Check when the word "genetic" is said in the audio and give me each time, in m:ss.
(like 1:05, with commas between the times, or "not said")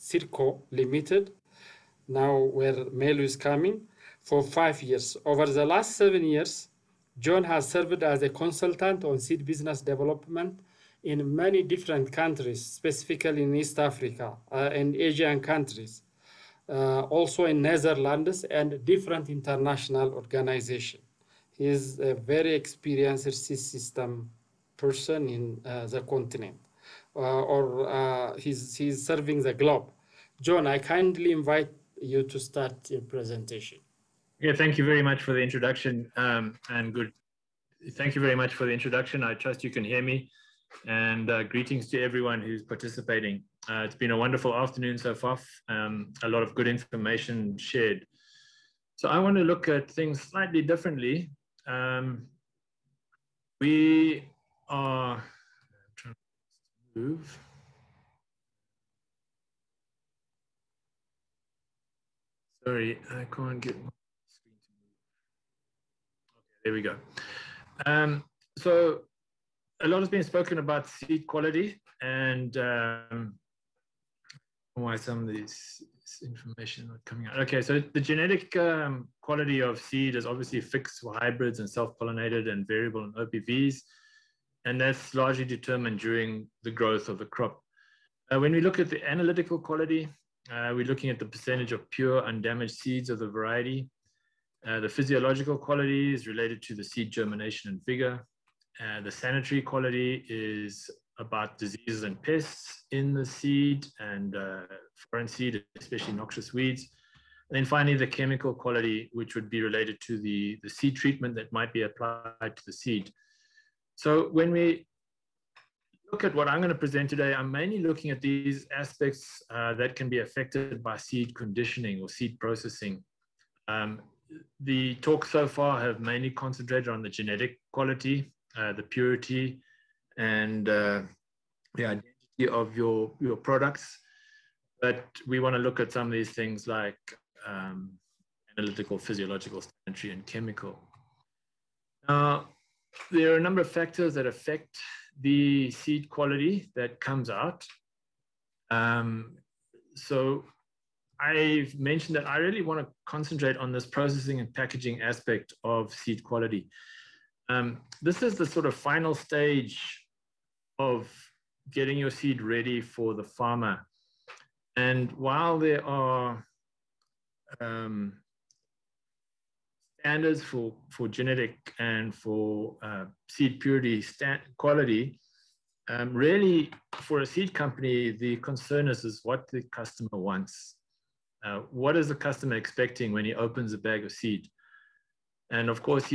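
1:18, 2:07, 2:51.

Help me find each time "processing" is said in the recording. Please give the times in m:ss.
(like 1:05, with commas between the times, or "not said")
2:02, 2:33.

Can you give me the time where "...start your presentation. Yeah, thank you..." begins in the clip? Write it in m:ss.
0:32.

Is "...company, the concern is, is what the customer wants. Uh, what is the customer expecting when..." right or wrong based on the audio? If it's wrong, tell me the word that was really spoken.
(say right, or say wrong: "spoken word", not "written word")
right.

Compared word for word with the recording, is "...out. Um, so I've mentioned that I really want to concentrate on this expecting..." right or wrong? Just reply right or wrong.
wrong.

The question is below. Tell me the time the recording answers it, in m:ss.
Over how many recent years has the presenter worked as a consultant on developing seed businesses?
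0:05.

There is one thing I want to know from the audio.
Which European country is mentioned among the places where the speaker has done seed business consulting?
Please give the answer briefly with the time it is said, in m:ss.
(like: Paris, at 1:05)
Netherlands, at 0:17.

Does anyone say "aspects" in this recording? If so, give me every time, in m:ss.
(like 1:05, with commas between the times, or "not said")
1:58, 2:35.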